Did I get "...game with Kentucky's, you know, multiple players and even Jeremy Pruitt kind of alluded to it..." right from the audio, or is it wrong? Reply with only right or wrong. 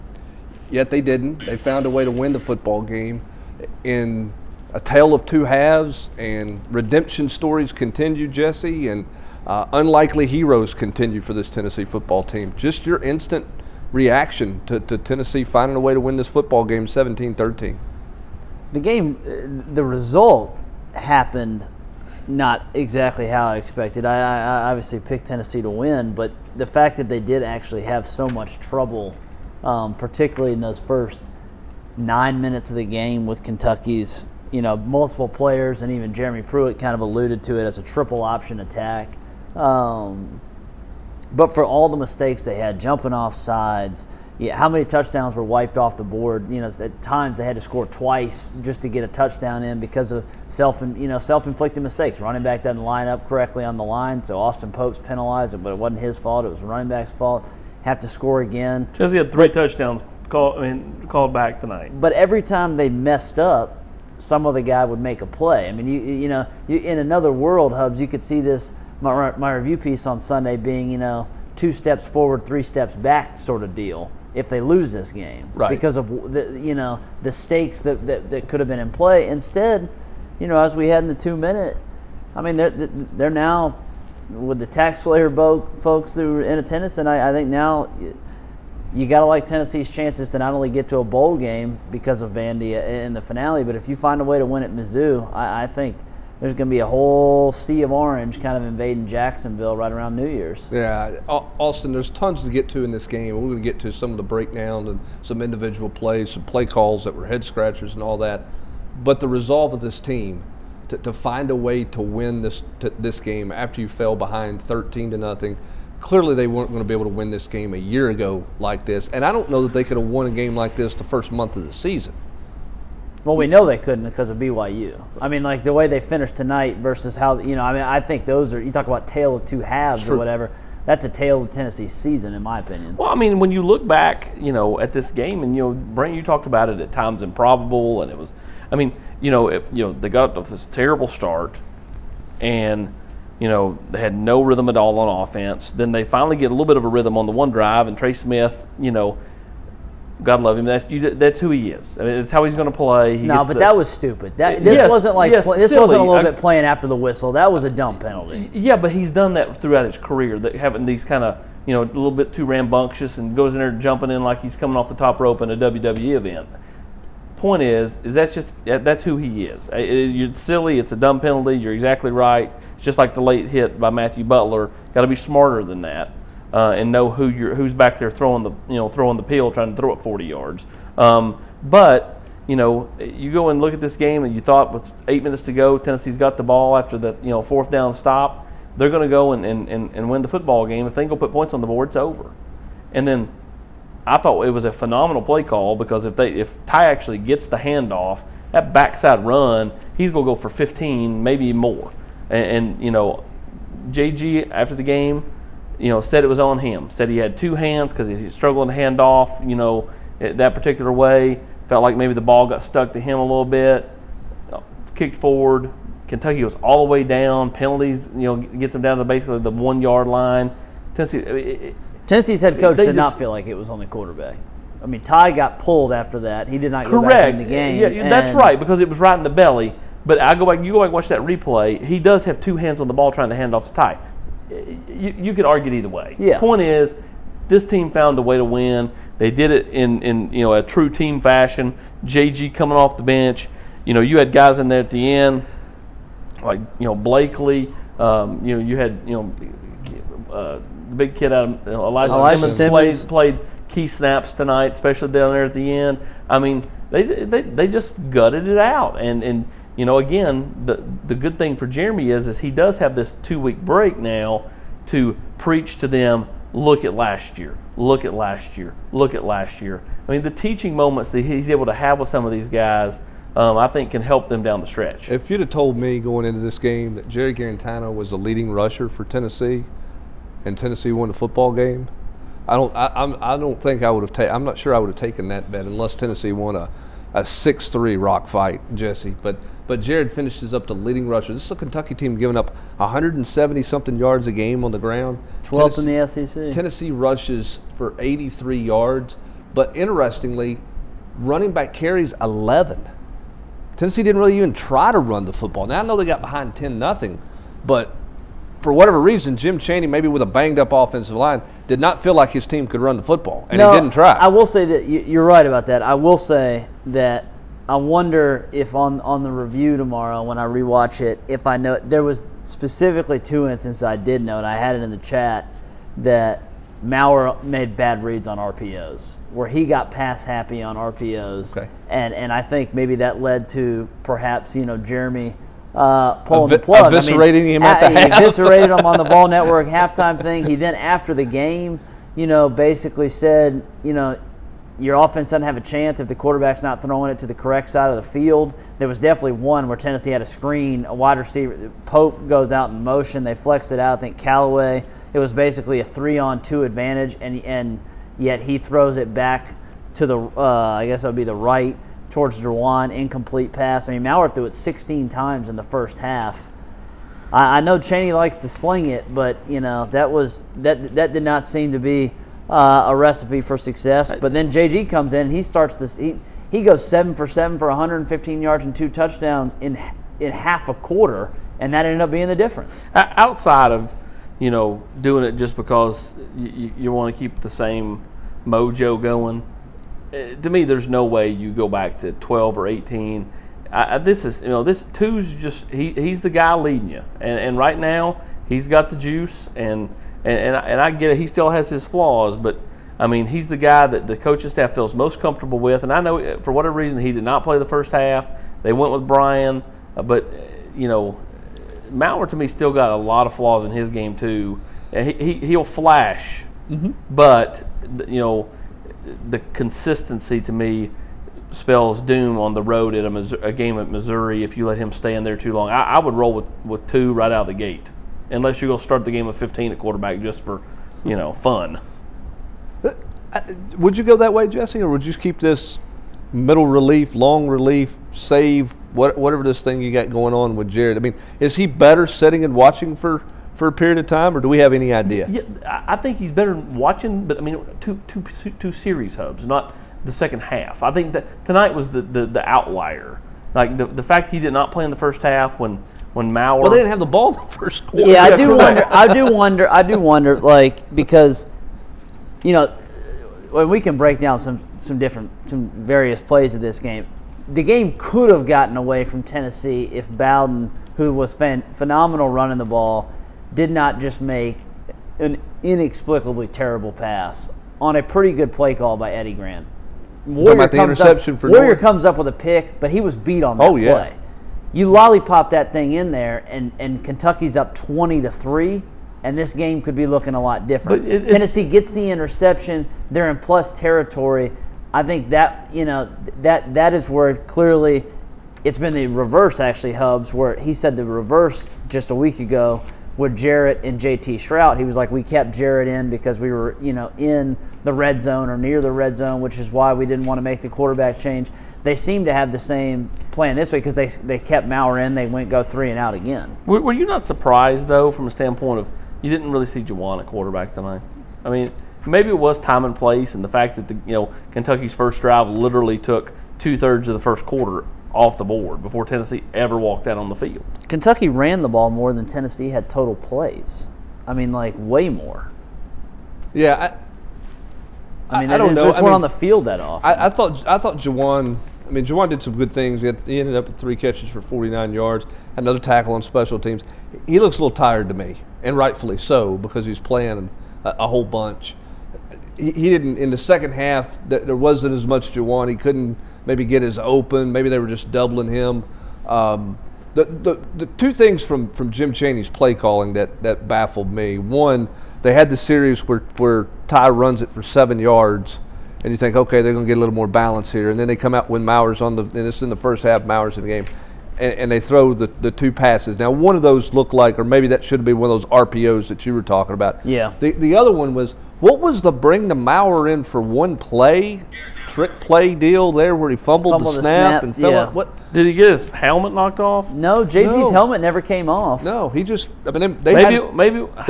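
right.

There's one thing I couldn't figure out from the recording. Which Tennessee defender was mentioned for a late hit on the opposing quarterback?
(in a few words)
Matthew Butler.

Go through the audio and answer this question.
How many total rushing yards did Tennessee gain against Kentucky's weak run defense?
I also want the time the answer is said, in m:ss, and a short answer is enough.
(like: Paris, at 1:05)
83, at 4:57.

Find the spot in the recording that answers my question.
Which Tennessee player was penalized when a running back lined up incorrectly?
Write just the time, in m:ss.
0:54.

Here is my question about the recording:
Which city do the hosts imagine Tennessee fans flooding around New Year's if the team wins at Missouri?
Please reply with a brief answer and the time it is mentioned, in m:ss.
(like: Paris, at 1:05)
Jacksonville, at 1:39.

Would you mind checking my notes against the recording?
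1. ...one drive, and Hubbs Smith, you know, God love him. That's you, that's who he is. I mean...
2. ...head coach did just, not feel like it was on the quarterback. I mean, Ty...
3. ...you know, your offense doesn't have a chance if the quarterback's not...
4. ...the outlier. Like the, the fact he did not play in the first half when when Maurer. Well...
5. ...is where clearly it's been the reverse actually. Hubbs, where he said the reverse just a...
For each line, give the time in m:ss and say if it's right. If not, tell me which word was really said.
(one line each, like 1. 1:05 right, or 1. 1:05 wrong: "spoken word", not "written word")
1. 2:27 wrong: "Trey", not "Hubbs"
2. 3:42 right
3. 5:43 right
4. 7:32 right
5. 8:16 right.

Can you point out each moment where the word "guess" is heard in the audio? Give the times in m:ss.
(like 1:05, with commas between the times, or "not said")
6:00.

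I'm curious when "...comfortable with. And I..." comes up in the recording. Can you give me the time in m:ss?
6:45.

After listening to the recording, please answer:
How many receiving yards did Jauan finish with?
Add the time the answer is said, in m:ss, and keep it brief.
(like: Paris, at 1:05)
49, at 9:04.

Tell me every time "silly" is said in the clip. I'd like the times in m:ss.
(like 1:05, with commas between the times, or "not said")
2:35, 2:50.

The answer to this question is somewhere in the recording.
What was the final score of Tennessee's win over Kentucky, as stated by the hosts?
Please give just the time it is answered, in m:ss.
0:16.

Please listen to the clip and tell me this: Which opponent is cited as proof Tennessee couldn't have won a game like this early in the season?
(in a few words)
BYU.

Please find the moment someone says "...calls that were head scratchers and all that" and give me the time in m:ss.
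1:46.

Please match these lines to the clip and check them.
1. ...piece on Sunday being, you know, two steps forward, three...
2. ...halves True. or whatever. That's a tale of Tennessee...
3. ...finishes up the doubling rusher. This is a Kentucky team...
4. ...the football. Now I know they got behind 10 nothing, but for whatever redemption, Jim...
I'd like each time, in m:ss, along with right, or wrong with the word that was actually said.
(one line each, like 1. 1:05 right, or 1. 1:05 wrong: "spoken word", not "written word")
1. 1:09 right
2. 2:09 right
3. 4:50 wrong: "leading", not "doubling"
4. 5:05 wrong: "reason", not "redemption".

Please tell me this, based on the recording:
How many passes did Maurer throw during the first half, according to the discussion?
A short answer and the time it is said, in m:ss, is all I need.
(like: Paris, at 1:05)
16, at 6:04.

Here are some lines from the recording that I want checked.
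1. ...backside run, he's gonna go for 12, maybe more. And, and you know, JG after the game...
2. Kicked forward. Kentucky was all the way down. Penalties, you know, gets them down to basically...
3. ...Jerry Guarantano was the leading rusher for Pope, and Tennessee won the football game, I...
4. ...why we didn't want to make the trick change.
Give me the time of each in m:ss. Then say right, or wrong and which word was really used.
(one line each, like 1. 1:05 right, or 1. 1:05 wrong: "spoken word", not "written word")
1. 3:18 wrong: "15", not "12"
2. 3:34 right
3. 4:37 wrong: "Tennessee", not "Pope"
4. 8:29 wrong: "quarterback", not "trick".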